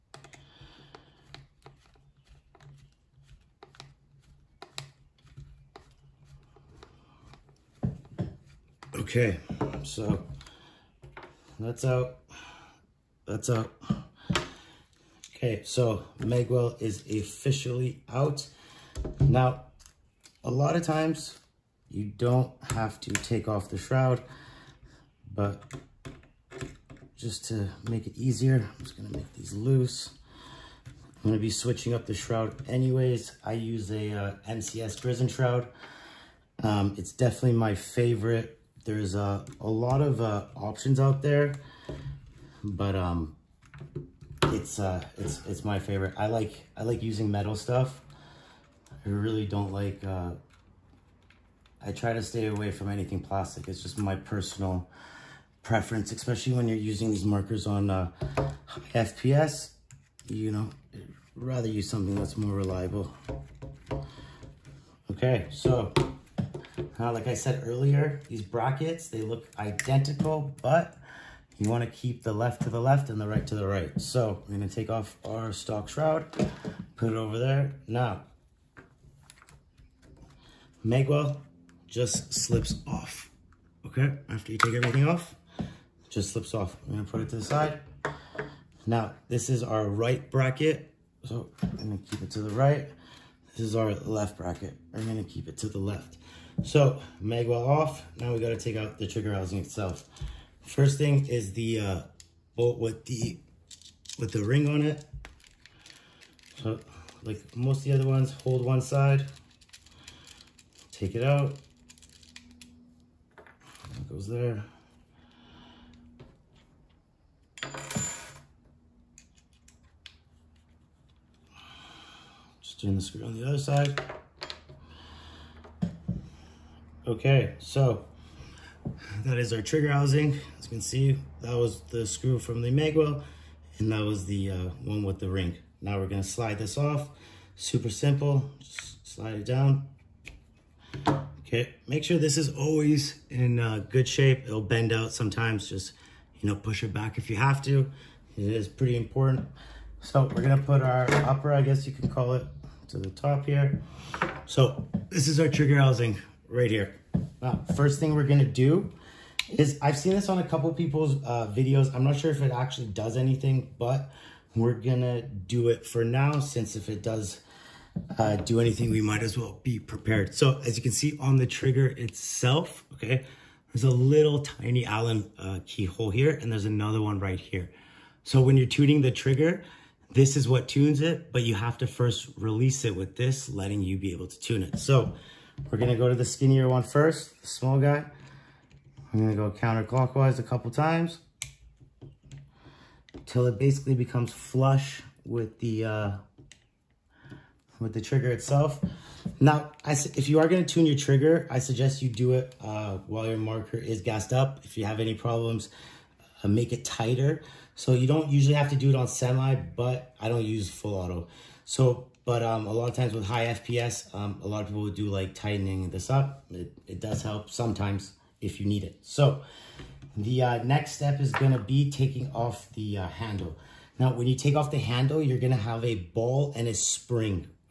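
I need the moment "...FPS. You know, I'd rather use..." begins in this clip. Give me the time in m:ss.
0:58.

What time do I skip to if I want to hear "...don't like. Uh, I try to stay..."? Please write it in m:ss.
0:49.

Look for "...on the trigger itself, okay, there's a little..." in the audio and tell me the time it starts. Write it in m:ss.
2:51.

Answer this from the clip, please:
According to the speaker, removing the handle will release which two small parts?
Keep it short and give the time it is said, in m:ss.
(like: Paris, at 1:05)
a ball and a spring, at 3:45.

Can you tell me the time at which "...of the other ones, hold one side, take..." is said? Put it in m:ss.
1:47.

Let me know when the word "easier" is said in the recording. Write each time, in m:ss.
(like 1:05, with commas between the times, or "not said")
0:28.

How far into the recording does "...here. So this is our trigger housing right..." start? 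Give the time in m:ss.
2:33.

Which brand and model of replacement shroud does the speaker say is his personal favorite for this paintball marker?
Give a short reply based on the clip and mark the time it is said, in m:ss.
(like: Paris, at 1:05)
NCS prison shroud, at 0:34.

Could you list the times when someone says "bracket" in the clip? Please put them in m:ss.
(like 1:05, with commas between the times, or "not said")
1:08, 1:30, 1:34.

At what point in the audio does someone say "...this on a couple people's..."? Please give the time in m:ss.
2:40.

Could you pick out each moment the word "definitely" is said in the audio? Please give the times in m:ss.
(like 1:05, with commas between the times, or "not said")
0:37.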